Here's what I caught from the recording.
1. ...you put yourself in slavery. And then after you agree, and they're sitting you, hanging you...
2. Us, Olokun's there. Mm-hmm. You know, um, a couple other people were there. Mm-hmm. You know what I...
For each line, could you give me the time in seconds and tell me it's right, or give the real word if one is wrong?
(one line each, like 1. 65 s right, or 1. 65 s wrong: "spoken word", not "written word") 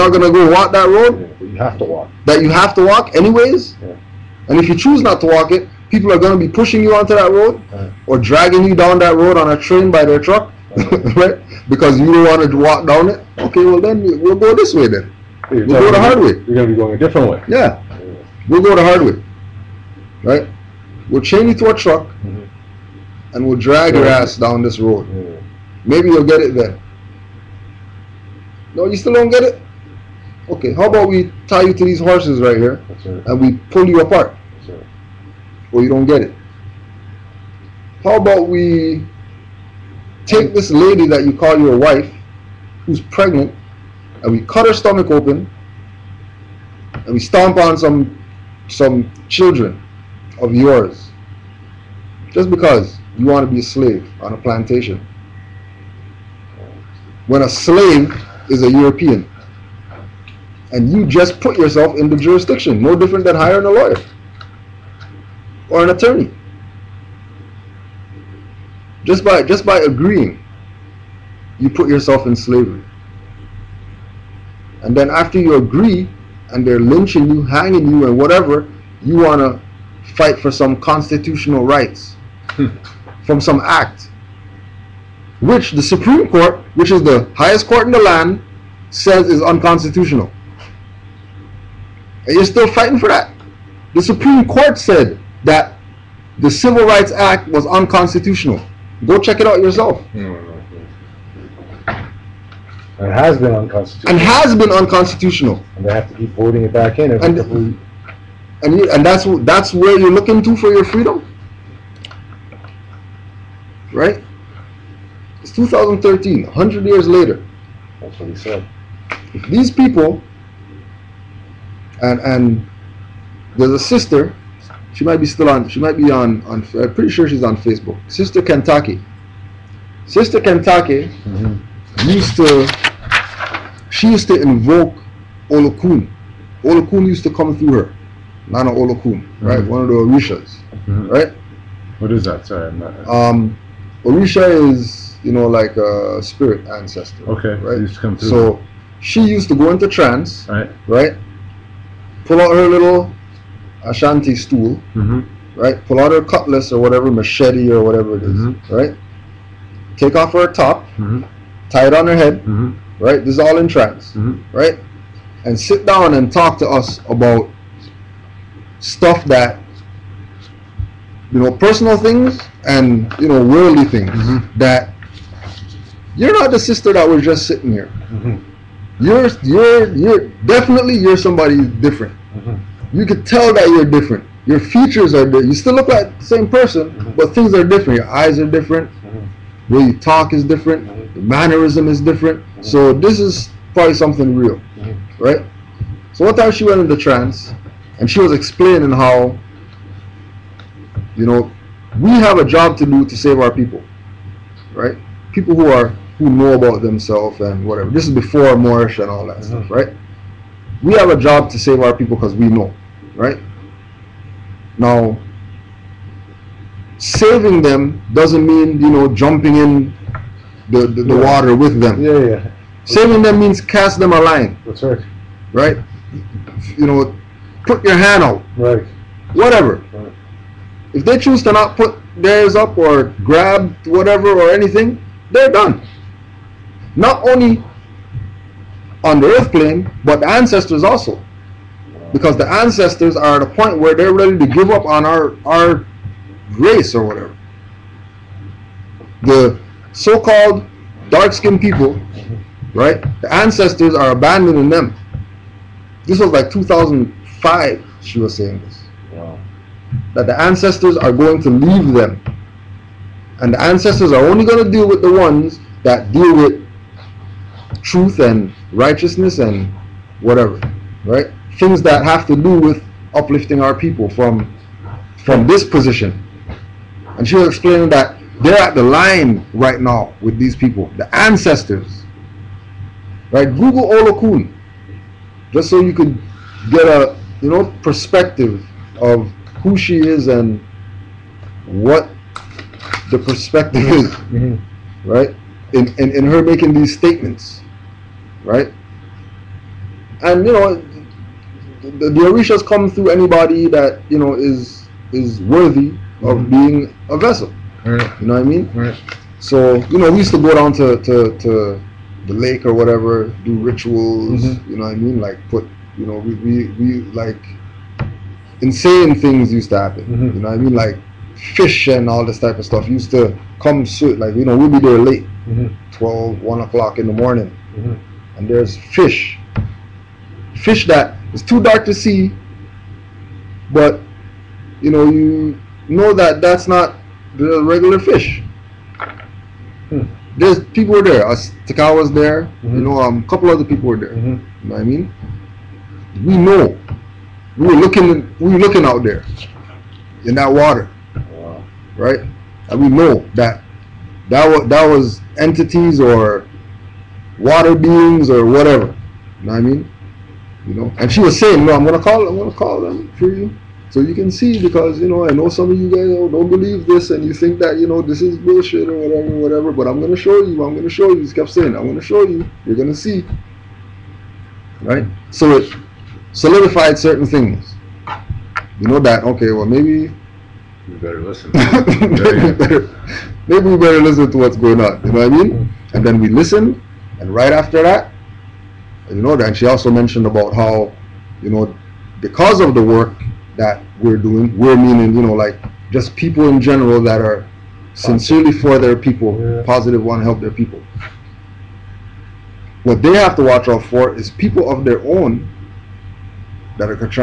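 1. 71 s wrong: "lynching", not "sitting"
2. 341 s wrong: "Takawa", not "Olokun".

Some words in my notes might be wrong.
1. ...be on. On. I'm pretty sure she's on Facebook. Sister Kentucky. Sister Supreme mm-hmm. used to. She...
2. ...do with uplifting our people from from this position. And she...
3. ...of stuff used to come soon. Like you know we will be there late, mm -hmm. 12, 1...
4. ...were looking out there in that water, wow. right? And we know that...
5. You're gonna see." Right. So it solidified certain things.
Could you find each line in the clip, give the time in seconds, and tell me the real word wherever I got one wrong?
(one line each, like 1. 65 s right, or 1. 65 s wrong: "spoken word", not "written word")
1. 125 s wrong: "Kentucky", not "Supreme"
2. 272 s right
3. 322 s right
4. 348 s right
5. 372 s right.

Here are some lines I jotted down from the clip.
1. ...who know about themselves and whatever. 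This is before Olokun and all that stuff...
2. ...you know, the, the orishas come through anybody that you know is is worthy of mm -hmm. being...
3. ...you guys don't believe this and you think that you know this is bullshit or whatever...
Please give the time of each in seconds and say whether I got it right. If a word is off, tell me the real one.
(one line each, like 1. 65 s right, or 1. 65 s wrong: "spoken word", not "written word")
1. 206 s wrong: "Moorish", not "Olokun"
2. 300 s right
3. 365 s right.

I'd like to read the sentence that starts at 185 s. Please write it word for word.
You still look like the same person, mm -hmm.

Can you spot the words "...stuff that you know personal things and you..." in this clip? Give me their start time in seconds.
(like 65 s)
168 s.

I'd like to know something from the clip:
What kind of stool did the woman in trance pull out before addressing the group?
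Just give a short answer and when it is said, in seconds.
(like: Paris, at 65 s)
Ashanti stool, at 153 s.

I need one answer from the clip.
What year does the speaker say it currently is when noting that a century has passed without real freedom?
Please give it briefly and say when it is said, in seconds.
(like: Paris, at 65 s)
2013, at 115 s.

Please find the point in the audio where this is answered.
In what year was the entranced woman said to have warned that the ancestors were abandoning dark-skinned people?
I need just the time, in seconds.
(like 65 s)
256 s.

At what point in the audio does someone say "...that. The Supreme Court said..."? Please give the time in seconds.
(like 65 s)
93 s.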